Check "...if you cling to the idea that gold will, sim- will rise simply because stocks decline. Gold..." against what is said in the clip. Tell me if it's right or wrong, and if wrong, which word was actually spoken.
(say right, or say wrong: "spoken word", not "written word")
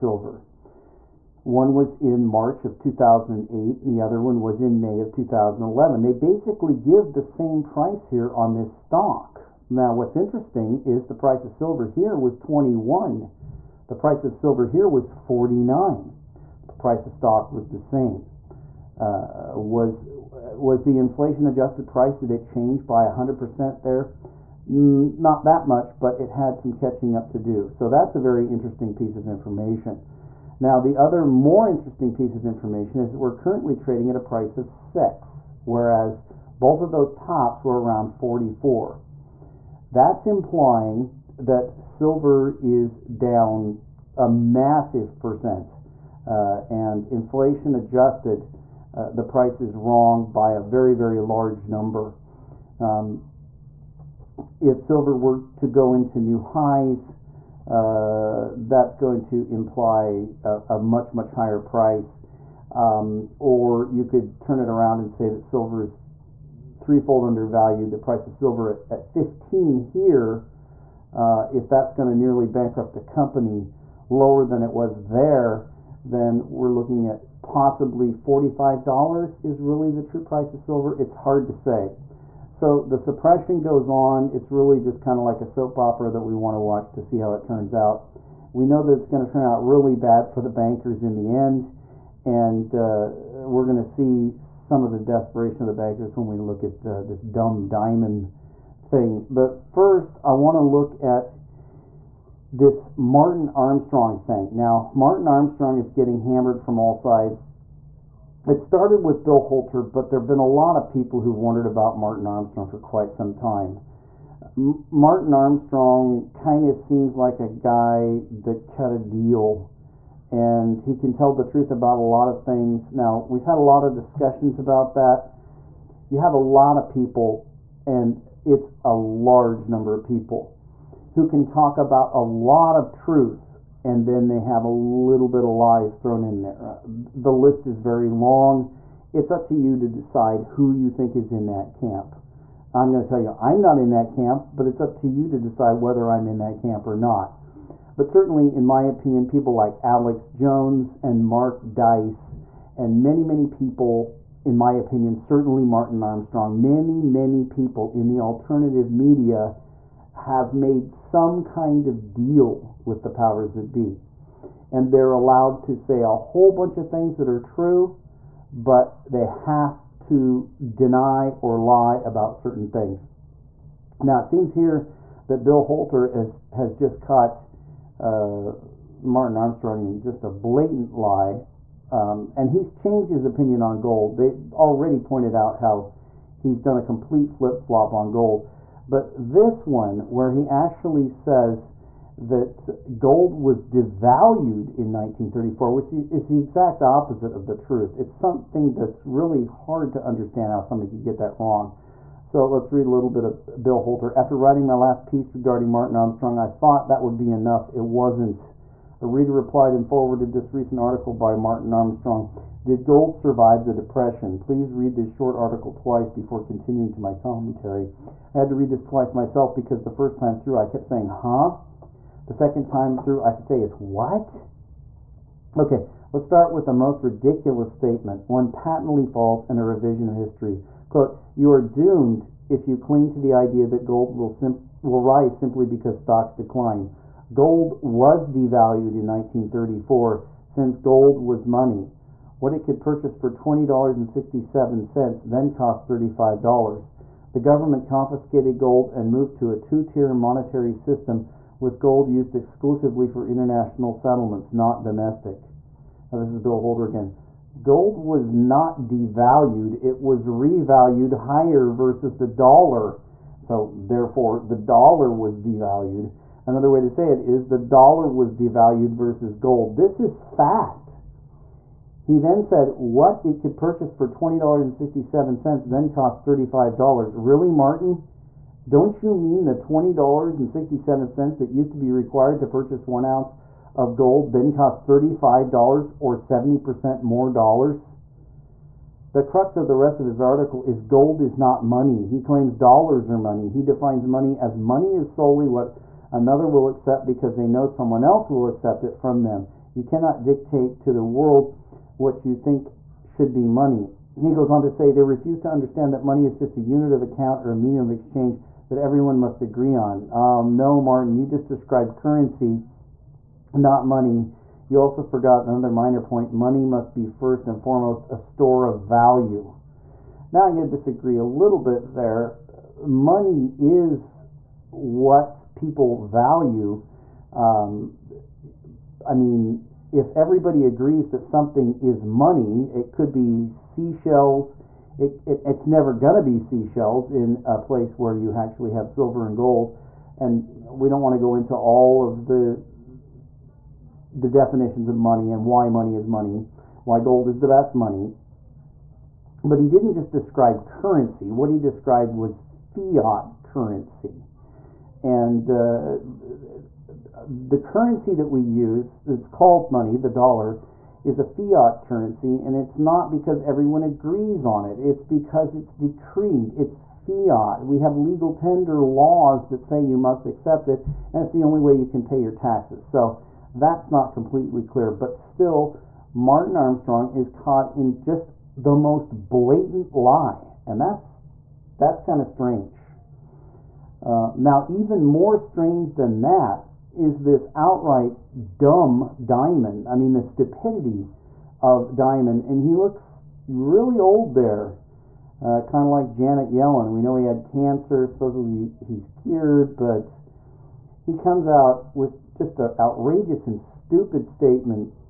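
right.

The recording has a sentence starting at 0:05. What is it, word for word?
They basically give the same price here on this stock.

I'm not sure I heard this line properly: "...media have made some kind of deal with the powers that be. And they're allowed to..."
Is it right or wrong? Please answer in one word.
right.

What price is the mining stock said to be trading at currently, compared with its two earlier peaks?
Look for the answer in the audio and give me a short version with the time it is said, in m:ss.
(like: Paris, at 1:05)
6, at 0:34.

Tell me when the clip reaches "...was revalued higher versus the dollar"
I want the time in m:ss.
4:19.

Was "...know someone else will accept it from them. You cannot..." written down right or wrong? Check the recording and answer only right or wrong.
right.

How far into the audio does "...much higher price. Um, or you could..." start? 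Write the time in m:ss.
1:01.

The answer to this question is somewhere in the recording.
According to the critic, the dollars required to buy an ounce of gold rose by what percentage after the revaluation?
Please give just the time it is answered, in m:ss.
4:46.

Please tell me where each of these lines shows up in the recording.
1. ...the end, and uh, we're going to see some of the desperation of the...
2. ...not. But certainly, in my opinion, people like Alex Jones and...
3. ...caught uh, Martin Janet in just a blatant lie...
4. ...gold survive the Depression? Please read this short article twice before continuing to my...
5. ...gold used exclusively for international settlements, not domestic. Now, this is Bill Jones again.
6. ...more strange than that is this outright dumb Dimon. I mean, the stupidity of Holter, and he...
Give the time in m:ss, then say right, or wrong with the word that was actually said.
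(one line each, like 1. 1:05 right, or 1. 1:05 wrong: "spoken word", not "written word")
1. 1:31 right
2. 2:26 right
3. 2:56 wrong: "Armstrong", not "Janet"
4. 3:32 right
5. 4:11 wrong: "Holter", not "Jones"
6. 6:25 wrong: "Dimon", not "Holter".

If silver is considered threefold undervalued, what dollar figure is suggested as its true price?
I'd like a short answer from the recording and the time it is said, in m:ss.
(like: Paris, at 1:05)
$45, at 1:18.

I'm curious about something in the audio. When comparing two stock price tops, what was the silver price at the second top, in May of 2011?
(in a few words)
49.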